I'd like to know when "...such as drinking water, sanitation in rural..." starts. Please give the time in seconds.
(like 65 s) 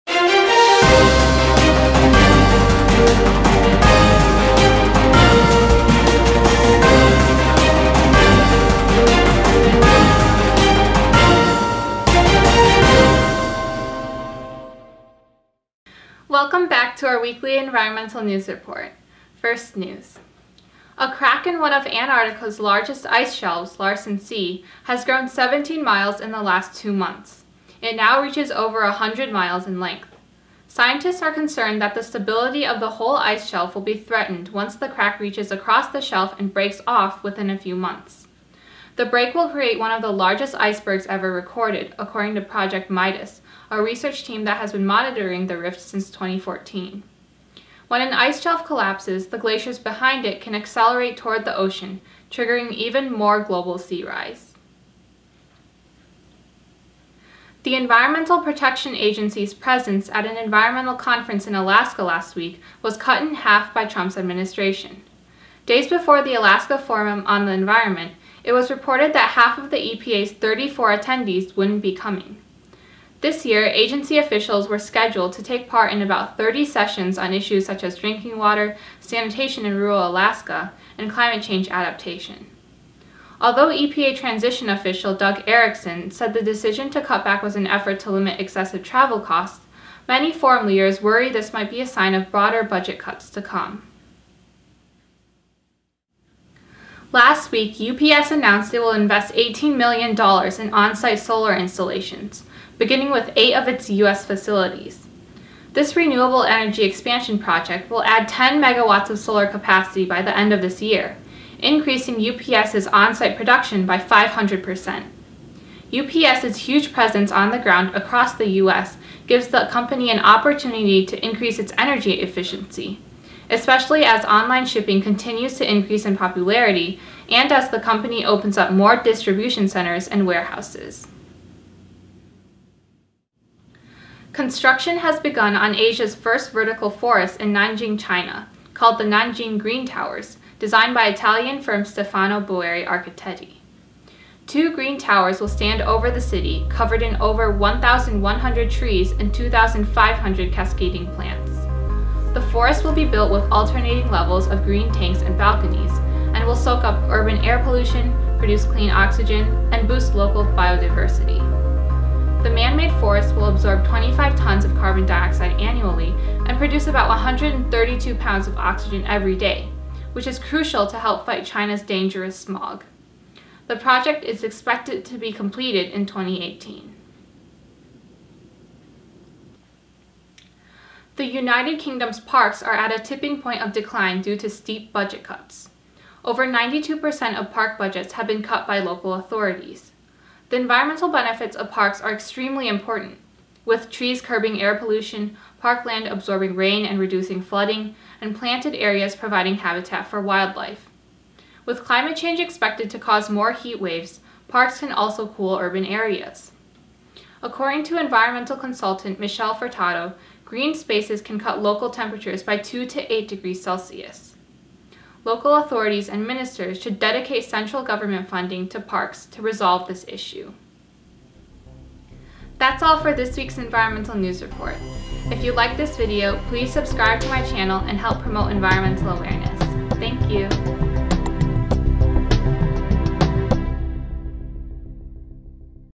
77 s.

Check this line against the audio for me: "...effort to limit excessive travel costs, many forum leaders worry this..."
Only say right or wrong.
right.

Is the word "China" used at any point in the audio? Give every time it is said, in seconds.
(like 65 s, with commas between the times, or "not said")
137 s, 171 s.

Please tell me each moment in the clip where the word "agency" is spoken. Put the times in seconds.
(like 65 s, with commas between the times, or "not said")
58 s, 73 s.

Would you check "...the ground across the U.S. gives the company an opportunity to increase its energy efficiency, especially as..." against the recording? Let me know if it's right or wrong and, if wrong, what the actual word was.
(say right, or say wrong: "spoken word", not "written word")
right.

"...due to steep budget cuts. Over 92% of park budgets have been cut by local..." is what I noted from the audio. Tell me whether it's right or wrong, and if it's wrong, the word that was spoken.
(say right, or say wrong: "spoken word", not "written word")
right.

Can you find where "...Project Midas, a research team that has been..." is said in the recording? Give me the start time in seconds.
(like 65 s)
42 s.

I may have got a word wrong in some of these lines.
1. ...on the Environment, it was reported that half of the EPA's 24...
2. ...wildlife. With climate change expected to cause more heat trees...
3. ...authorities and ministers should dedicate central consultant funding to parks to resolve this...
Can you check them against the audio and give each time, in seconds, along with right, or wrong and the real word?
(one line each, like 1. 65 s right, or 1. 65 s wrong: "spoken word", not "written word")
1. 67 s wrong: "34", not "24"
2. 200 s wrong: "waves", not "trees"
3. 215 s wrong: "government", not "consultant".